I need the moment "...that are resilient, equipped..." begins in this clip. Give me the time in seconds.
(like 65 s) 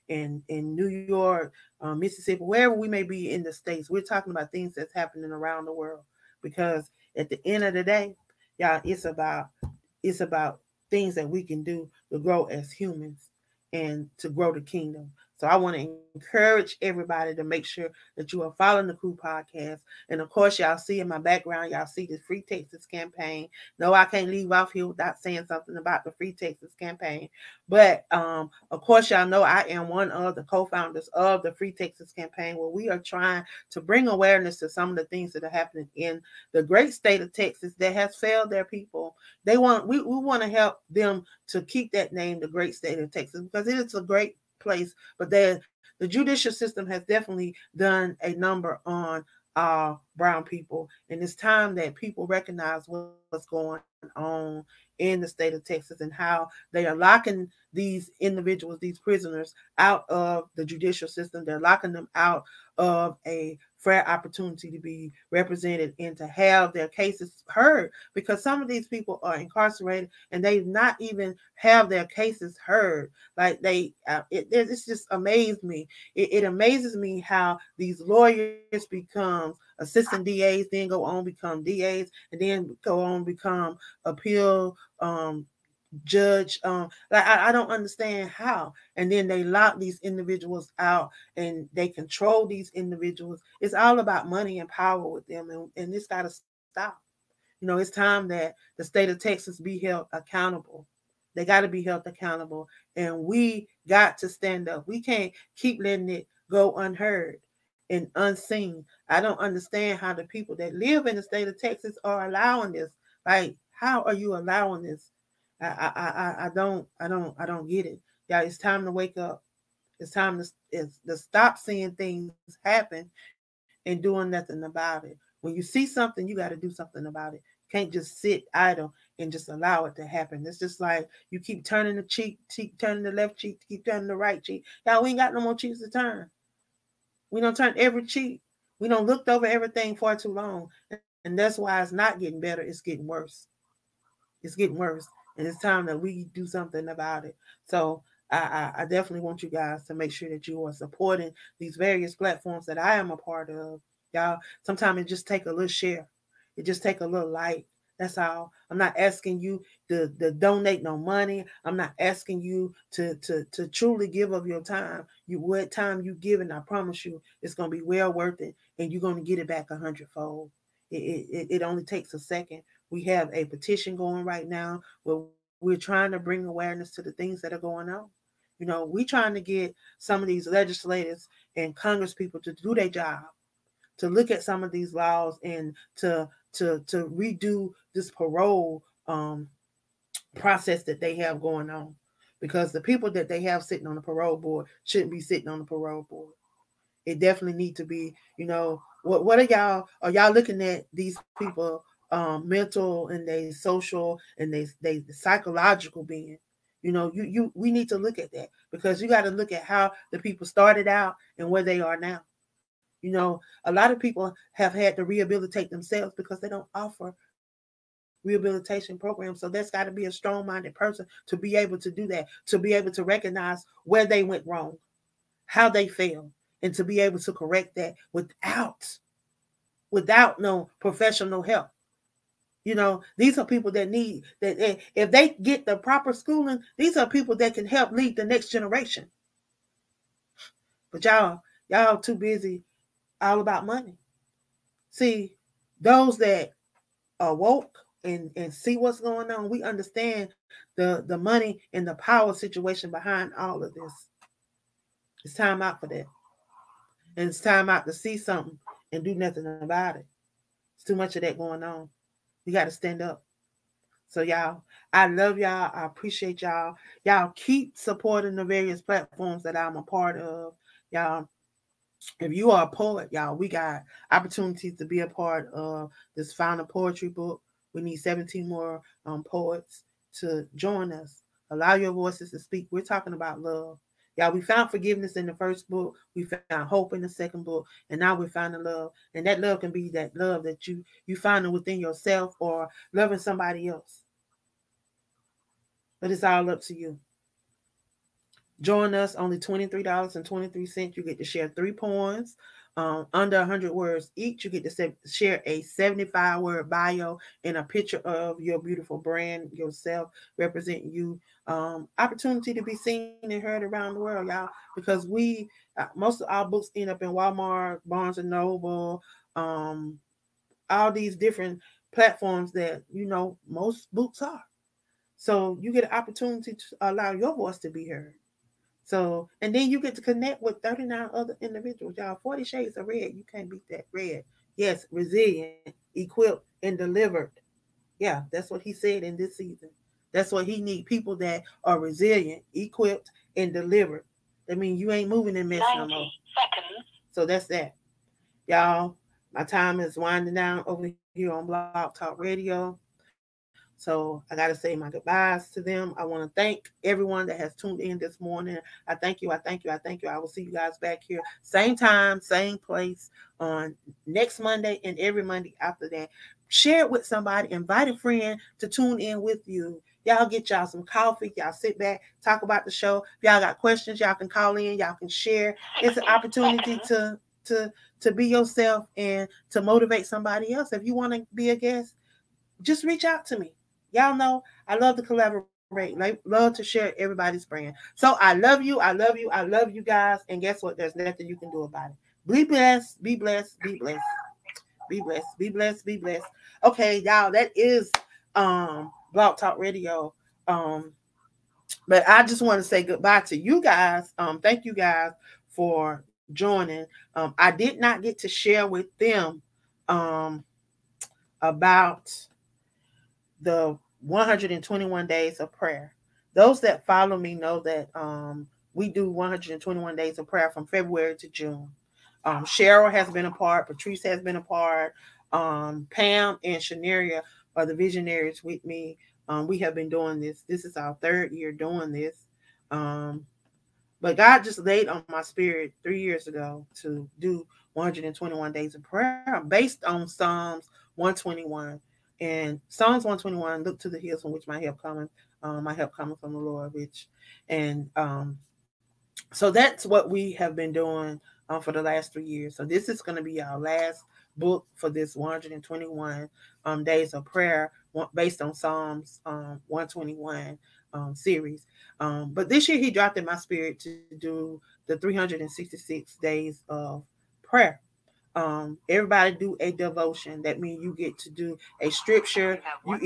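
341 s.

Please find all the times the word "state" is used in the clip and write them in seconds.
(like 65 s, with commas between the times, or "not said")
3 s, 36 s, 42 s, 55 s, 98 s, 111 s.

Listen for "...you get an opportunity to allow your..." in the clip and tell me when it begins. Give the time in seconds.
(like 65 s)
325 s.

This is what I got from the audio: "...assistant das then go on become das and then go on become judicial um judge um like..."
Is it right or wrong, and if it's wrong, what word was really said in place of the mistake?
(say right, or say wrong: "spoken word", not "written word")
wrong: "appeal", not "judicial".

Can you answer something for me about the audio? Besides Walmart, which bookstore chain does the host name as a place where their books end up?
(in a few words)
Barnes and Noble.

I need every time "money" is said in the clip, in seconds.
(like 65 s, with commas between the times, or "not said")
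94 s, 160 s, 243 s, 251 s.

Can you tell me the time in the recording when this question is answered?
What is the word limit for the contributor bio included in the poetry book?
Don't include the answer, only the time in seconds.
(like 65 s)
305 s.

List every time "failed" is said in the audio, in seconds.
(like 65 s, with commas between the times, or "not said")
38 s, 225 s.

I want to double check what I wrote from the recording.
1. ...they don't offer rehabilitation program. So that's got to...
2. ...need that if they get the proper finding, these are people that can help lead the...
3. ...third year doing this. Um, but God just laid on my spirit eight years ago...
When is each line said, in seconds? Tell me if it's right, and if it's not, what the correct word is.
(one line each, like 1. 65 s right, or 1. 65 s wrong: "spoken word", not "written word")
1. 216 s right
2. 233 s wrong: "schooling", not "finding"
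3. 431 s wrong: "three", not "eight".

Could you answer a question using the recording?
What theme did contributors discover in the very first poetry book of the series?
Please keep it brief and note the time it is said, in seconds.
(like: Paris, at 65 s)
forgiveness, at 284 s.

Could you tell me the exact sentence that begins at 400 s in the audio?
Um, but I just want to say goodbye to you guys.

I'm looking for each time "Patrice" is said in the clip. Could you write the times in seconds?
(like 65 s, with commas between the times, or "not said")
423 s.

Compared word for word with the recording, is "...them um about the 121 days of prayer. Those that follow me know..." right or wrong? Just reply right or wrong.
right.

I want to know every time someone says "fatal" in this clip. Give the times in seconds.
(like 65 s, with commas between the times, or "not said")
not said.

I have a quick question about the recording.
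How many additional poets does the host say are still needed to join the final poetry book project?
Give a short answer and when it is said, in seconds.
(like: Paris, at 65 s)
17, at 277 s.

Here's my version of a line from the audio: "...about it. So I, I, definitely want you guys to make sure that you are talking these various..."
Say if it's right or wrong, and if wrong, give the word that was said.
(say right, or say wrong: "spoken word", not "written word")
wrong: "supporting", not "talking".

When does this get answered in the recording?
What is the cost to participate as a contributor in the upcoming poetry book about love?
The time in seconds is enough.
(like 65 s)
299 s.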